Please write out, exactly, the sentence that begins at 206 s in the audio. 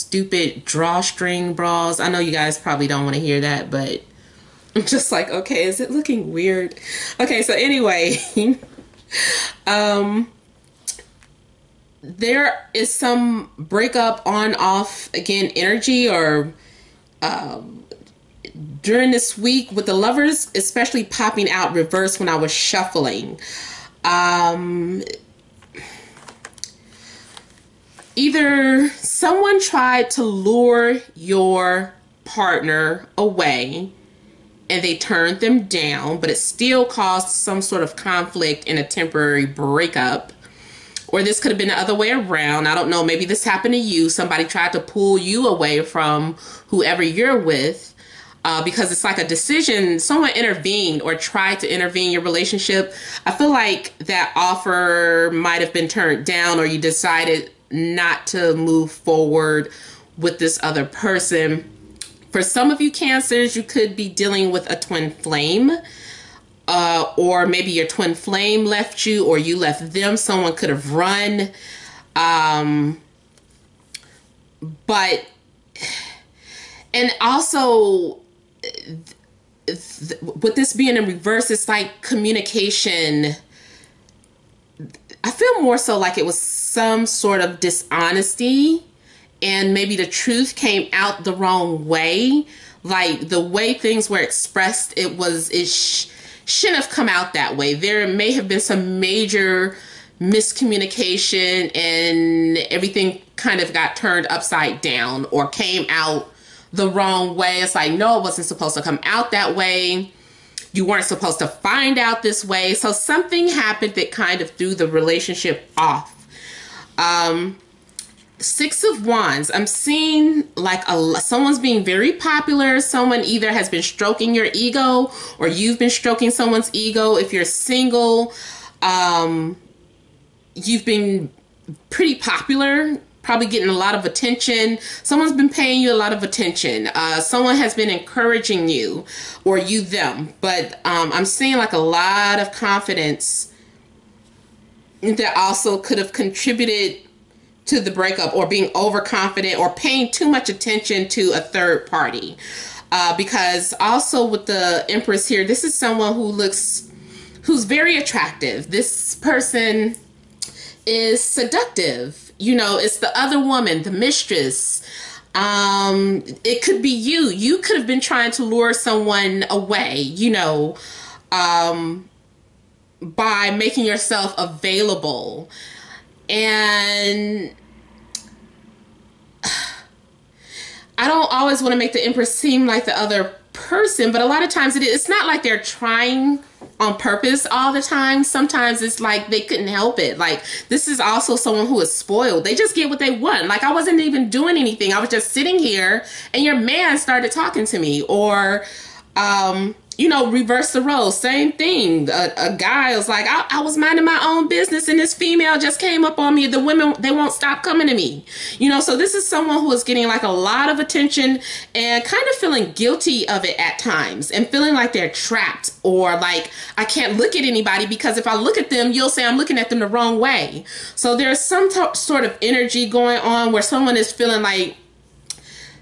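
The women, they won't stop coming to me.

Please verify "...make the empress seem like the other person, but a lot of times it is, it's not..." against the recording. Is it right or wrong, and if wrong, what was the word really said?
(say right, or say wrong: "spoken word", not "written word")
right.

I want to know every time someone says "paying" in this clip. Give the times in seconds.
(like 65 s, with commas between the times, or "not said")
135 s, 149 s.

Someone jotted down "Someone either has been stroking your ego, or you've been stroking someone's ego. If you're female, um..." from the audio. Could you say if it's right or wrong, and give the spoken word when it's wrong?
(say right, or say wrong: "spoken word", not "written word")
wrong: "single", not "female".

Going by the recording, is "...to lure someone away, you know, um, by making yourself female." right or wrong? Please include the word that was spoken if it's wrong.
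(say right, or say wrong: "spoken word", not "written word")
wrong: "available", not "female".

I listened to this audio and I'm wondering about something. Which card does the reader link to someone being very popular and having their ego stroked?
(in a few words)
Six of Wands.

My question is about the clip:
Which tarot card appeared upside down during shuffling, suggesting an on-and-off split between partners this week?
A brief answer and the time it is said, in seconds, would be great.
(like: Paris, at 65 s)
The Lovers, at 19 s.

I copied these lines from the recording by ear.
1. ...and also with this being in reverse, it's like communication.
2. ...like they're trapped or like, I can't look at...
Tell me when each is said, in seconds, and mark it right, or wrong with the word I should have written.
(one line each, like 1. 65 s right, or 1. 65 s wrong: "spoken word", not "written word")
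1. 76 s right
2. 214 s right.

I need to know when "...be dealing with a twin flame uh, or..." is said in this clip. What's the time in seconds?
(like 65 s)
63 s.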